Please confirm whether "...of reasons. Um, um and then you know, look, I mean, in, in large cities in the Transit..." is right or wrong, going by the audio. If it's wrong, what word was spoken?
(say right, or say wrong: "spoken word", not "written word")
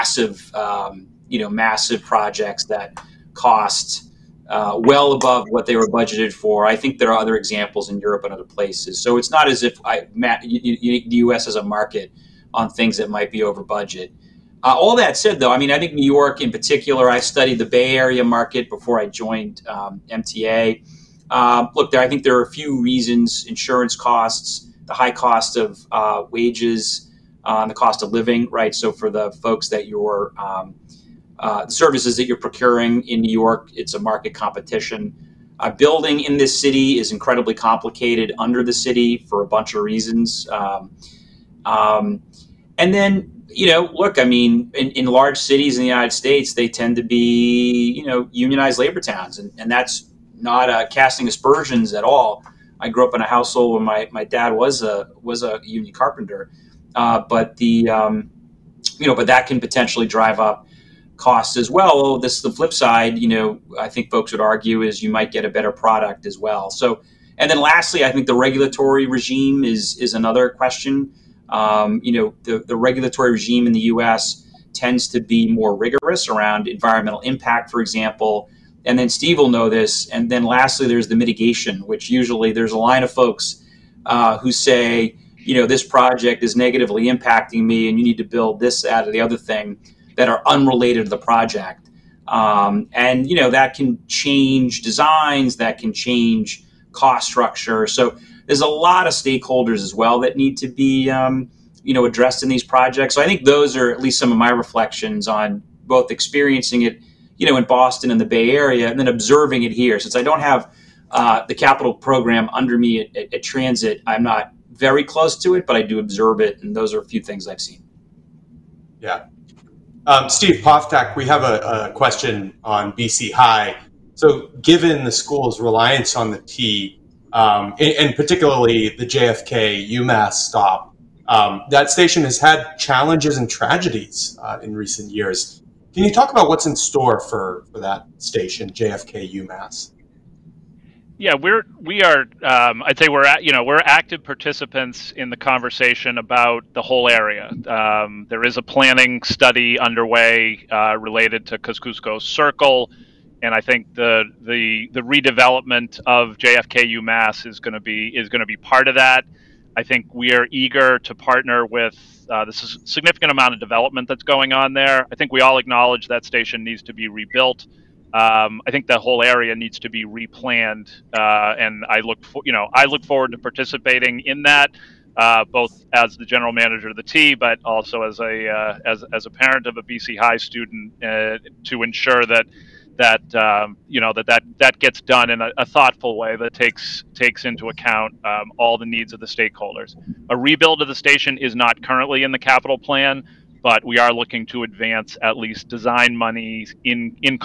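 wrong: "United", not "Transit".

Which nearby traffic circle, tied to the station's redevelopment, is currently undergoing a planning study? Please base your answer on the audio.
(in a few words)
Kosciuszko Circle.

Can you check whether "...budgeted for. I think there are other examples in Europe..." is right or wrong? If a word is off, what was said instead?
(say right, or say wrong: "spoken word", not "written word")
right.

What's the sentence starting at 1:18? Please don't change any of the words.
And then Steve will know this.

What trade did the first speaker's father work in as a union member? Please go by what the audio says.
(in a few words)
Carpenter.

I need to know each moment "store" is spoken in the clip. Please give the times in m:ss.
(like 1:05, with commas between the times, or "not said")
2:16.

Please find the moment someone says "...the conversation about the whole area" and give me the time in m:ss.
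2:25.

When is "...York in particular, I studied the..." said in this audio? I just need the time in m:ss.
0:16.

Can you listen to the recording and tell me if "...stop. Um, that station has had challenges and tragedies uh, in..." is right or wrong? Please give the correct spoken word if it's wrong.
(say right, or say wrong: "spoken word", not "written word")
right.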